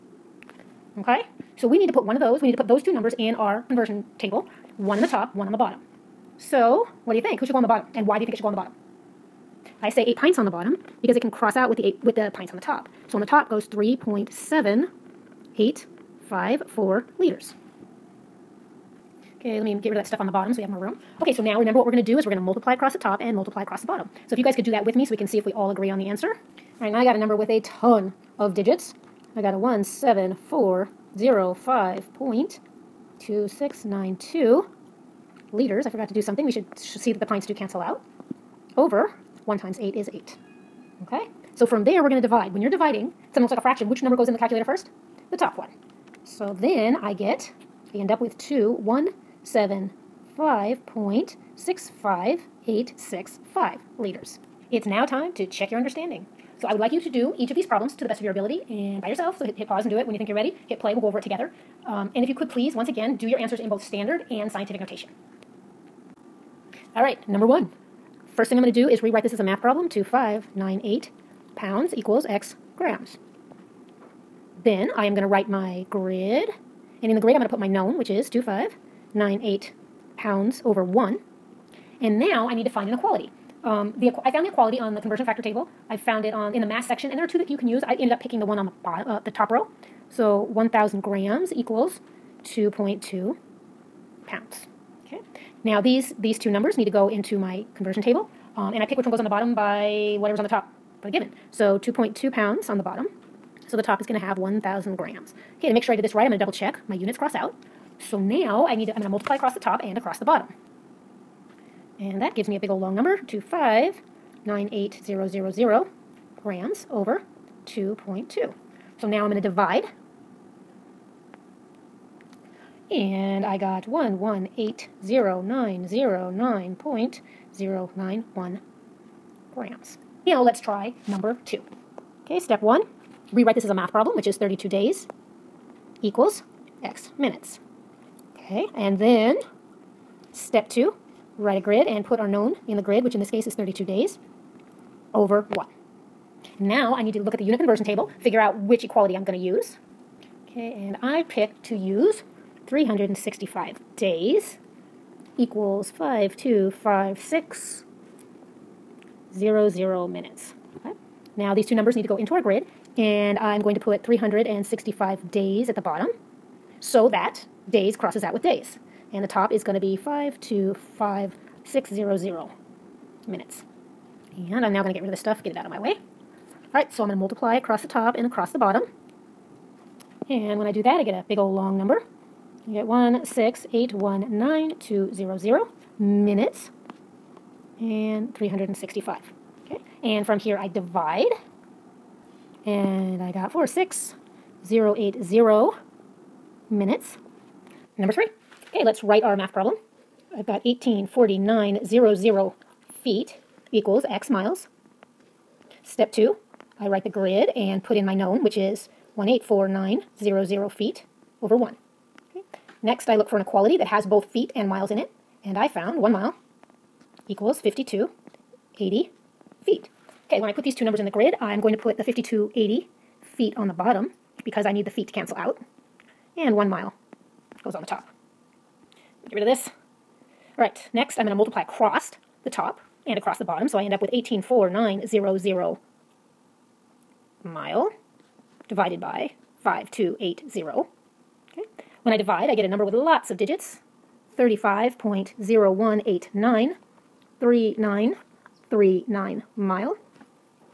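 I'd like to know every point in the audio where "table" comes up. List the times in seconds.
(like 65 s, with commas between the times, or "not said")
4 s, 85 s, 98 s, 147 s.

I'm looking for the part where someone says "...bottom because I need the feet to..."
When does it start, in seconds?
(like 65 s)
223 s.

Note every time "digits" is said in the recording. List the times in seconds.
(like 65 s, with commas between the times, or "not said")
28 s, 243 s.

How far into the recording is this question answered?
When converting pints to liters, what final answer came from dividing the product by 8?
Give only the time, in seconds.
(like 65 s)
48 s.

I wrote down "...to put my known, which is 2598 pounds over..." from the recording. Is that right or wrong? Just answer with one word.
right.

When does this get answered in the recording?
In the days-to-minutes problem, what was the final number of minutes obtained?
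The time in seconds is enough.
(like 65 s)
193 s.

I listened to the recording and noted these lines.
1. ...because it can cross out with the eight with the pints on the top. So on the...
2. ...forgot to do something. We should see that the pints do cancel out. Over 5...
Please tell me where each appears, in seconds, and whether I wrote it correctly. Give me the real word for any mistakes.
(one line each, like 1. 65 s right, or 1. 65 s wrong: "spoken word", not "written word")
1. 11 s right
2. 35 s wrong: "1", not "5".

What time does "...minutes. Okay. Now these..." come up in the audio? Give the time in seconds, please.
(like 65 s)
160 s.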